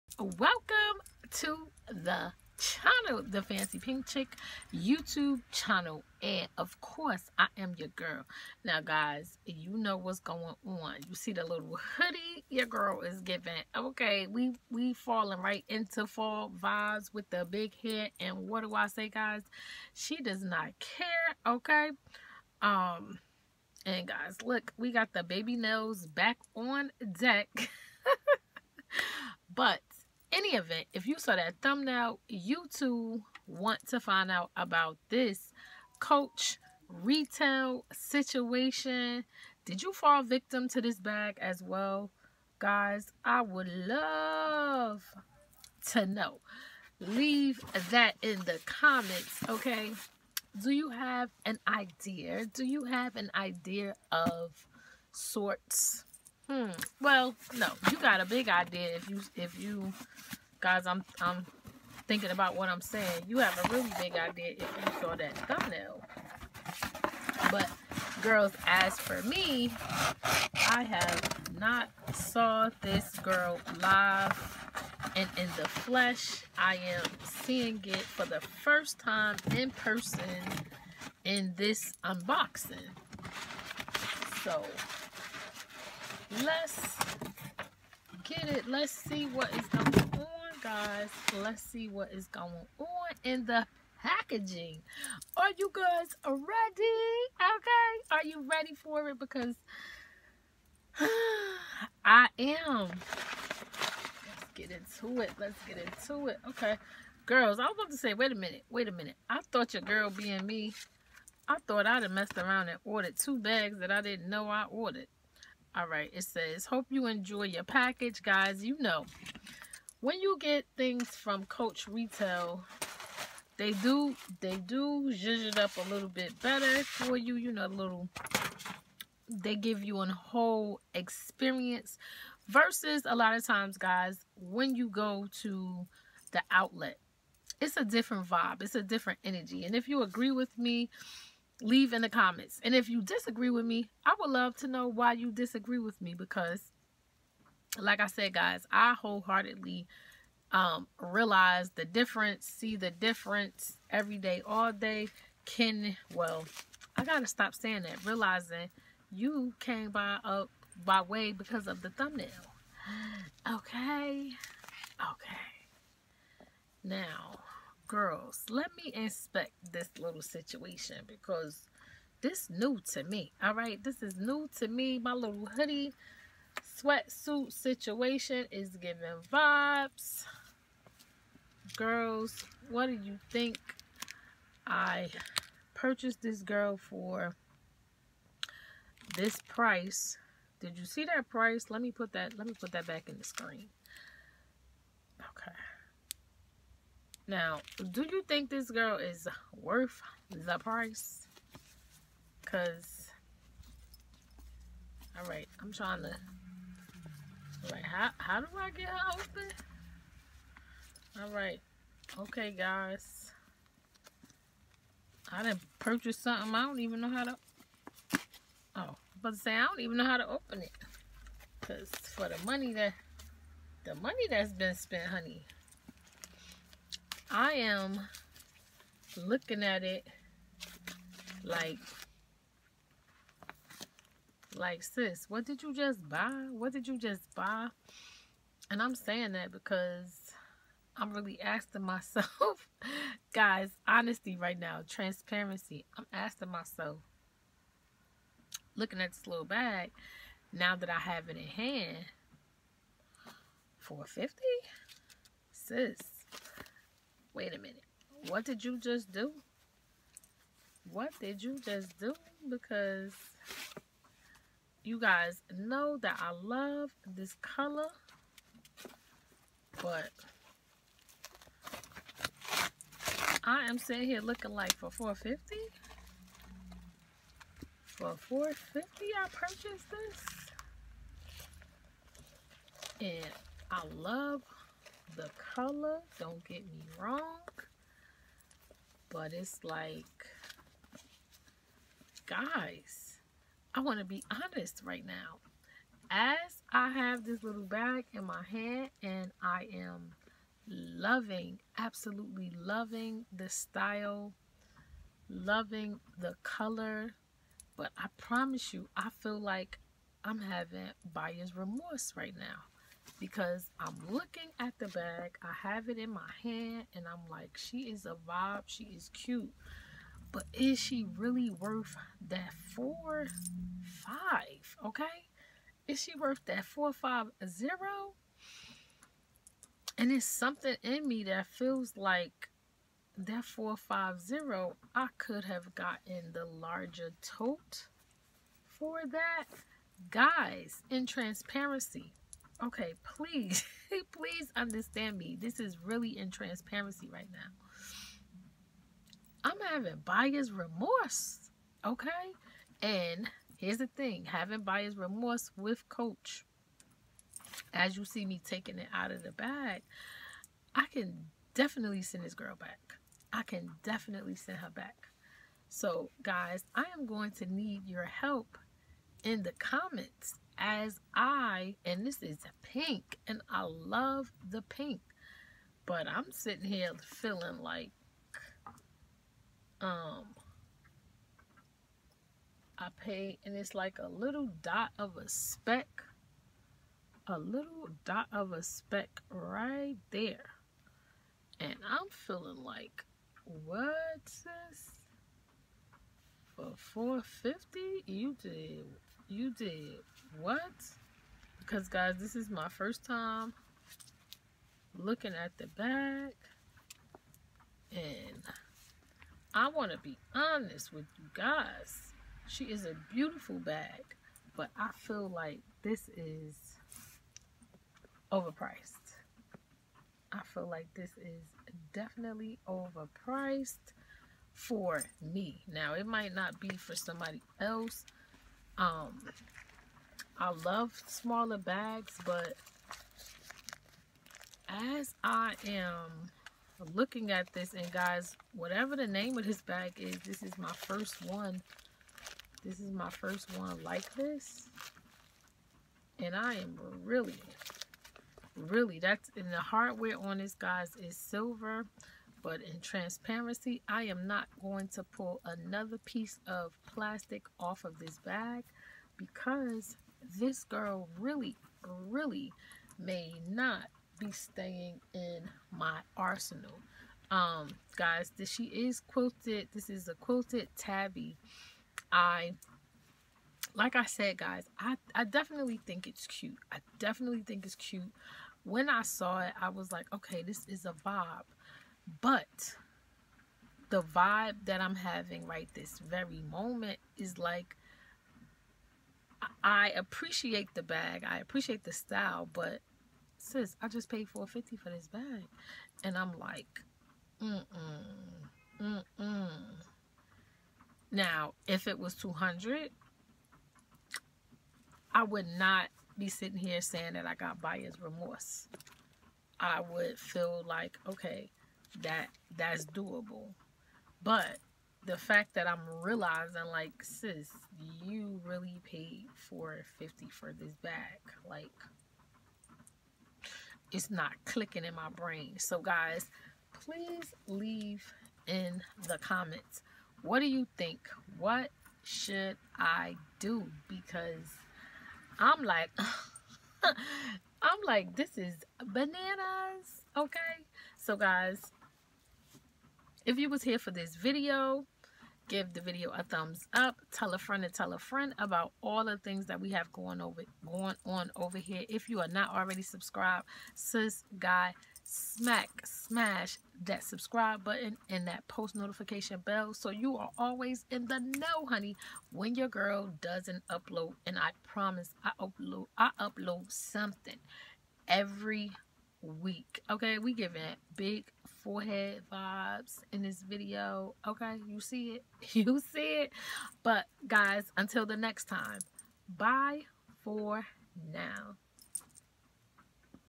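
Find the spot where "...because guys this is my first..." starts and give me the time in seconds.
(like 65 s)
401 s.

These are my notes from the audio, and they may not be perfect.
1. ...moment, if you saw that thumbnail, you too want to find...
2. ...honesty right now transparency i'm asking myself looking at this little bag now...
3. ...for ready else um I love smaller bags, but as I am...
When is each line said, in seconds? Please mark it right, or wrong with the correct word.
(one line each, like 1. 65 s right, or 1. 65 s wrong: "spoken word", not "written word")
1. 30 s wrong: "event", not "moment"
2. 243 s right
3. 426 s wrong: "somebody", not "ready".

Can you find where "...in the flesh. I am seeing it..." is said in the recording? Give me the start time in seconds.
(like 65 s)
75 s.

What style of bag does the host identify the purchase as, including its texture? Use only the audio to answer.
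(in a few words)
Quilted tabby.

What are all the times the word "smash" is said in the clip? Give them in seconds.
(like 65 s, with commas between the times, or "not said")
555 s.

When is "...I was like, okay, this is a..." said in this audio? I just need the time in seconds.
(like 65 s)
479 s.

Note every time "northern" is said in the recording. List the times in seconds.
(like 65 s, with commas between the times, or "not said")
not said.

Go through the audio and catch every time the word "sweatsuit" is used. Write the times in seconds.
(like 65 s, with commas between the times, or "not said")
176 s.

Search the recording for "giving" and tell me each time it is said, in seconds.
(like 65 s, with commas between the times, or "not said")
13 s, 178 s, 570 s.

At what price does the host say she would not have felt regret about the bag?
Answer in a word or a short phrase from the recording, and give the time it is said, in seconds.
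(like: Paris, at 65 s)
200, at 502 s.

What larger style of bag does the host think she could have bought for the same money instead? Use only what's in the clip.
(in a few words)
Tote.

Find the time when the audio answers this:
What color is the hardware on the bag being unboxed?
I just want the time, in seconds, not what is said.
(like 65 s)
451 s.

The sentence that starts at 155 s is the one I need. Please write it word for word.
Can, well, I got to stop saying that, realizing you came by up by way because of the thumbnail.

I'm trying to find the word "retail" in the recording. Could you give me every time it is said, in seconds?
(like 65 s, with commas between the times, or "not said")
36 s, 121 s.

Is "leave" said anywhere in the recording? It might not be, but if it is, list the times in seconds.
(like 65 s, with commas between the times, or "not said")
46 s, 141 s, 527 s.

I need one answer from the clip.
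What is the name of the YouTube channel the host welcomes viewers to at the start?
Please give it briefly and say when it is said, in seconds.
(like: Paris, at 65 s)
The Fancy Pink Chick, at 3 s.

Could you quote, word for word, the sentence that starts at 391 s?
And I'm feeling like, what's this?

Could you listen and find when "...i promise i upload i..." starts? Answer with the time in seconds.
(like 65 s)
564 s.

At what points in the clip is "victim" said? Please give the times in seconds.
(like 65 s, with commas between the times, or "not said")
40 s.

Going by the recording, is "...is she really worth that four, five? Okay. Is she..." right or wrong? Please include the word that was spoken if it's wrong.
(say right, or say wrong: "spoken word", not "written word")
right.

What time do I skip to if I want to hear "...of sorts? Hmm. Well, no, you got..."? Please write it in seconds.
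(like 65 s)
54 s.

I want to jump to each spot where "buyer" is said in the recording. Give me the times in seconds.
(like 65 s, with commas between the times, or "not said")
311 s, 350 s, 354 s, 507 s.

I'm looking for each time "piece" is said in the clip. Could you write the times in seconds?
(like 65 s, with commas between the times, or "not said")
456 s.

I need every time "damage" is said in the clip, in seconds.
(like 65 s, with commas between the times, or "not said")
not said.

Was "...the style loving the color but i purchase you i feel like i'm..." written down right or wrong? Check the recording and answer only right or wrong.
wrong.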